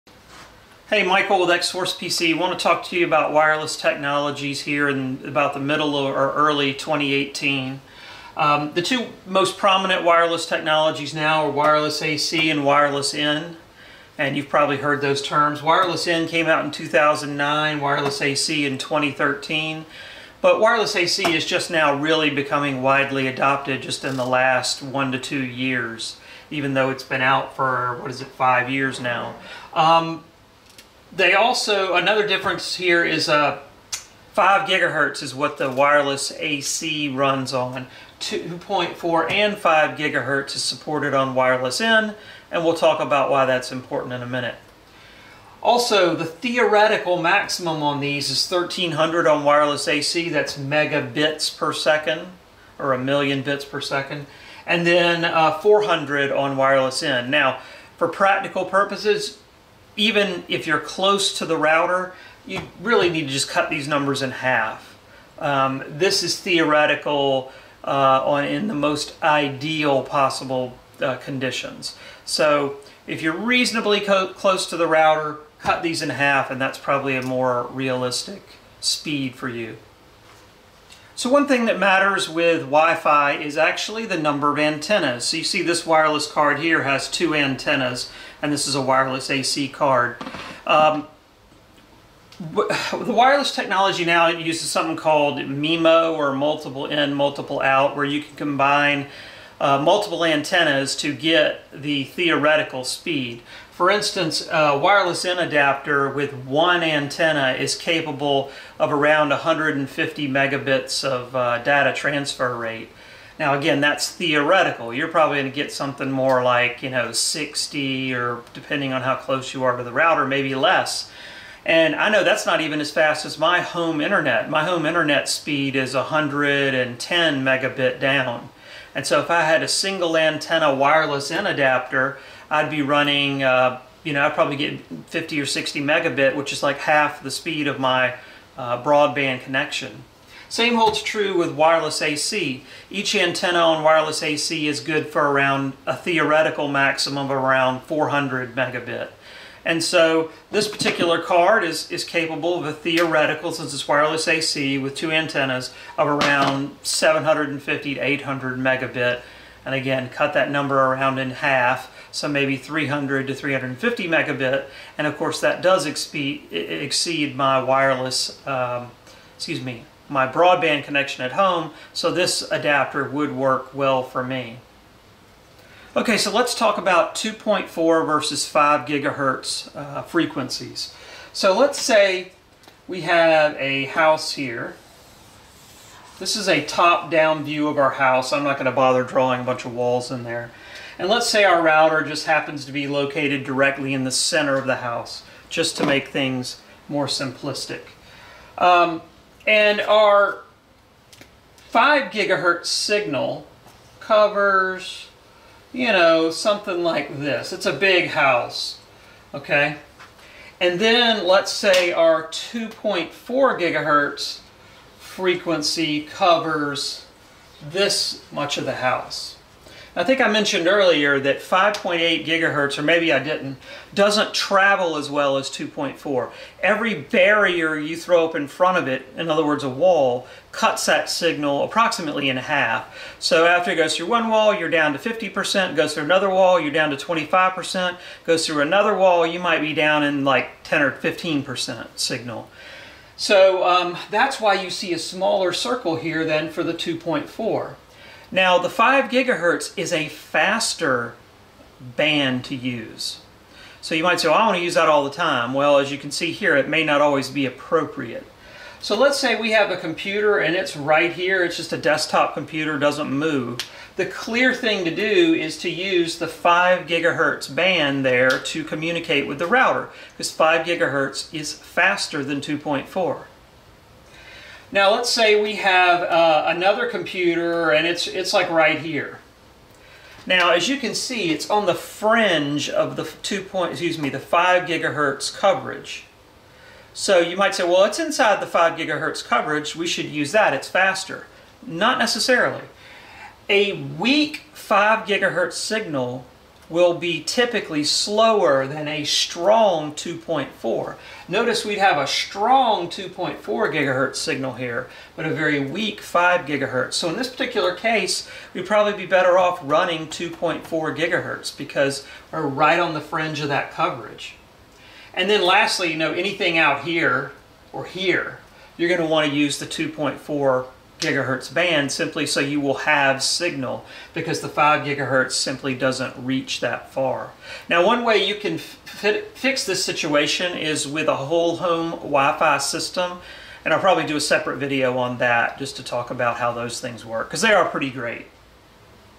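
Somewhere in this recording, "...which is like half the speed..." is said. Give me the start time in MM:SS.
02:16.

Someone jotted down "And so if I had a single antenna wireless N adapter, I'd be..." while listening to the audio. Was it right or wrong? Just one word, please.
right.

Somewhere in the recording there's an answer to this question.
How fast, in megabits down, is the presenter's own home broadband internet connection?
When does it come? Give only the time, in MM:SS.
02:05.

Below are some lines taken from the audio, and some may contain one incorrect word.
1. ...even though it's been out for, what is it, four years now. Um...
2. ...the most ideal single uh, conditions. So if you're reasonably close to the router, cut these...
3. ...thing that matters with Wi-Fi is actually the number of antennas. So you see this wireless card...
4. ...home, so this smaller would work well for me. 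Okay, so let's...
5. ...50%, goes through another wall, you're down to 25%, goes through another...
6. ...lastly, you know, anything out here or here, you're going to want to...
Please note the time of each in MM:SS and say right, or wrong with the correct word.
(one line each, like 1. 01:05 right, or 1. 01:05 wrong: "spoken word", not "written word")
1. 00:26 wrong: "five", not "four"
2. 01:08 wrong: "possible", not "single"
3. 01:21 right
4. 02:51 wrong: "adapter", not "smaller"
5. 03:54 right
6. 05:15 right.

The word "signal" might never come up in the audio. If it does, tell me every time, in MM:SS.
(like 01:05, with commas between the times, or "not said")
03:22, 03:51, 04:01, 04:55, 05:04, 05:23.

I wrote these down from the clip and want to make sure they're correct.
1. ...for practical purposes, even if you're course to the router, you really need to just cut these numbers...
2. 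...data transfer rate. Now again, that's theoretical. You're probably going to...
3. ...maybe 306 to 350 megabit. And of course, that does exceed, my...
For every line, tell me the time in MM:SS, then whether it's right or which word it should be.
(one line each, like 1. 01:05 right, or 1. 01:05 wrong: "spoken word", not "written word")
1. 00:57 wrong: "close", not "course"
2. 01:51 right
3. 02:42 wrong: "300", not "306".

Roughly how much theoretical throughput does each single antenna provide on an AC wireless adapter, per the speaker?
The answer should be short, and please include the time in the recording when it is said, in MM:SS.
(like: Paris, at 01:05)
400 megabit, at 02:27.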